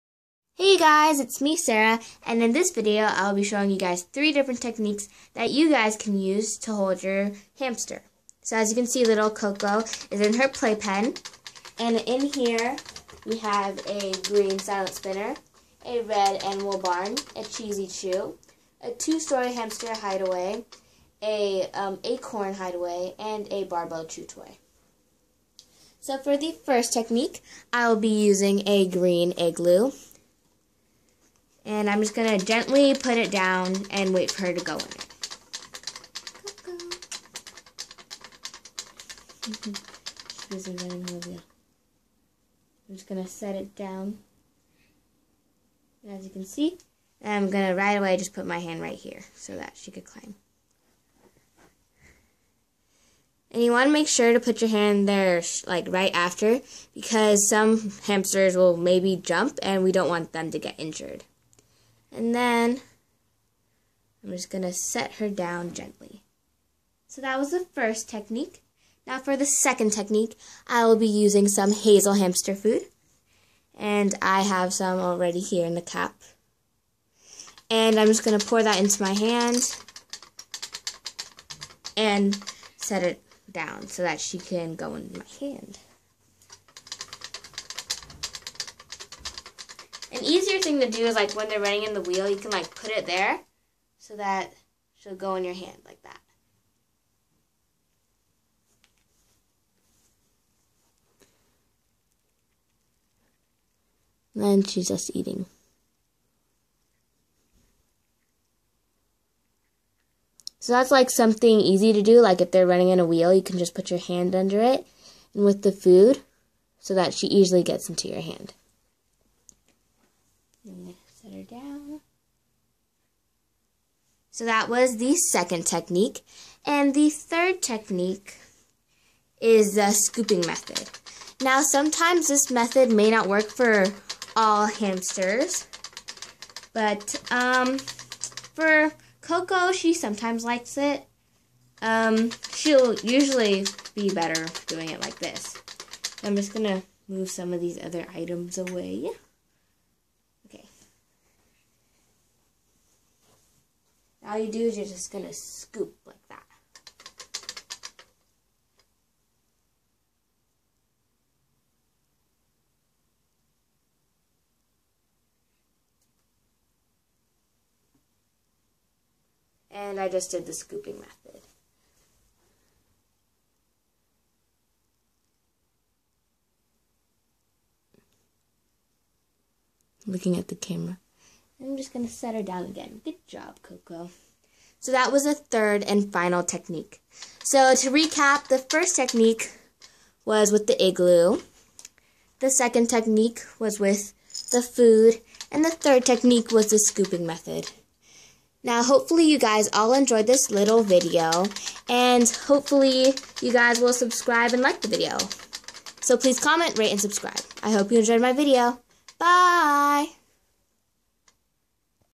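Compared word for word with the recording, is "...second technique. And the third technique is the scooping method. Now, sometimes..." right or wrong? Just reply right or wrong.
right.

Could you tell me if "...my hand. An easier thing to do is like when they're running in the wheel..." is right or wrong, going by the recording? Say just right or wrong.
right.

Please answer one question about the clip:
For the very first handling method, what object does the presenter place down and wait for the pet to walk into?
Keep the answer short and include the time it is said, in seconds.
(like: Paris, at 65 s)
green igloo, at 28 s.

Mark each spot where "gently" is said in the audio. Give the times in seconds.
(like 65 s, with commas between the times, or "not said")
32 s, 65 s.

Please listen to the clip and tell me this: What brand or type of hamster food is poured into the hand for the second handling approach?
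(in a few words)
hazel hamster food.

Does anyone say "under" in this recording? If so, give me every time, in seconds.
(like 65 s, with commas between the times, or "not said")
114 s.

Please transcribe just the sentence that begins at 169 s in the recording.
And I just did the scooping method.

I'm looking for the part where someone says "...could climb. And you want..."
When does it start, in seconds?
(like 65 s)
49 s.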